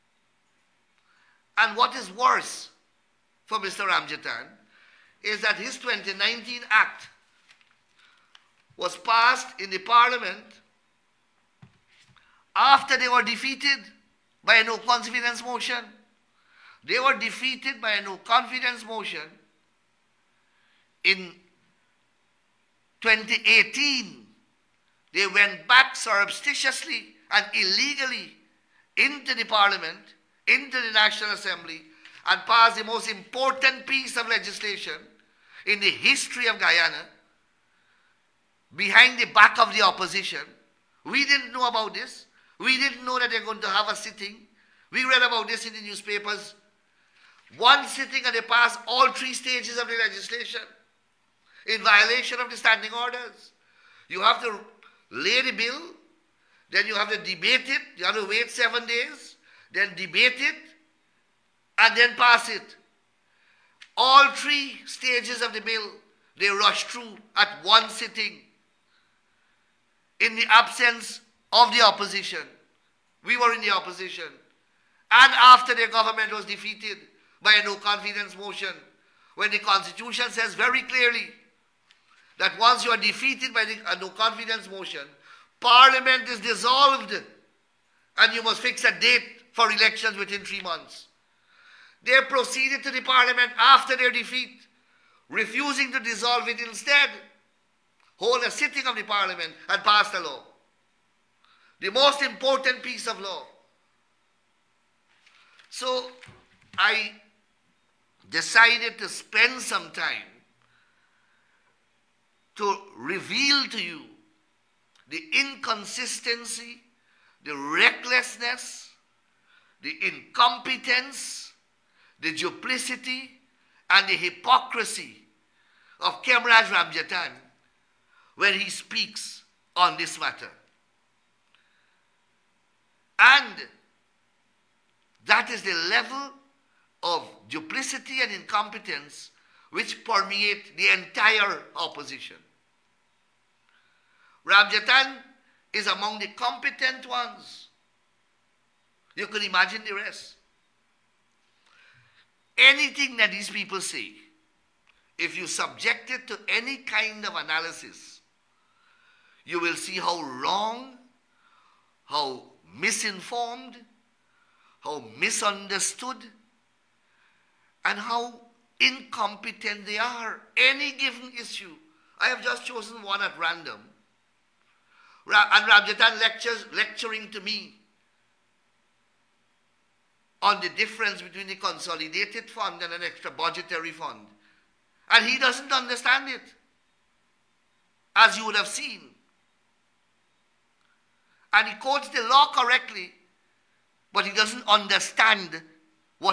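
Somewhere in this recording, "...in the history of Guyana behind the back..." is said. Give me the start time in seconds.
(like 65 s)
35 s.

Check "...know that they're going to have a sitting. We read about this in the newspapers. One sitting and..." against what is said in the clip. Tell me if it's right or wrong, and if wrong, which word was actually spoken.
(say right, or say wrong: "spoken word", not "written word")
right.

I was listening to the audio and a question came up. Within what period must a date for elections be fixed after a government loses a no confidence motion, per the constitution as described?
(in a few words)
3 months.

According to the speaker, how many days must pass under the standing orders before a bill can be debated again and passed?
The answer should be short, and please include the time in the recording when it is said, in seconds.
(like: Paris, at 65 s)
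7, at 58 s.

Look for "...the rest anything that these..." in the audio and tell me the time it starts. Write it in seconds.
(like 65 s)
149 s.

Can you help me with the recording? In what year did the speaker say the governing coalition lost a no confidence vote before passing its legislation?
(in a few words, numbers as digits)
2018.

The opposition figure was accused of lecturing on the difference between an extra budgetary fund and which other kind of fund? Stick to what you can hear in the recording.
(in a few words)
Consolidated fund.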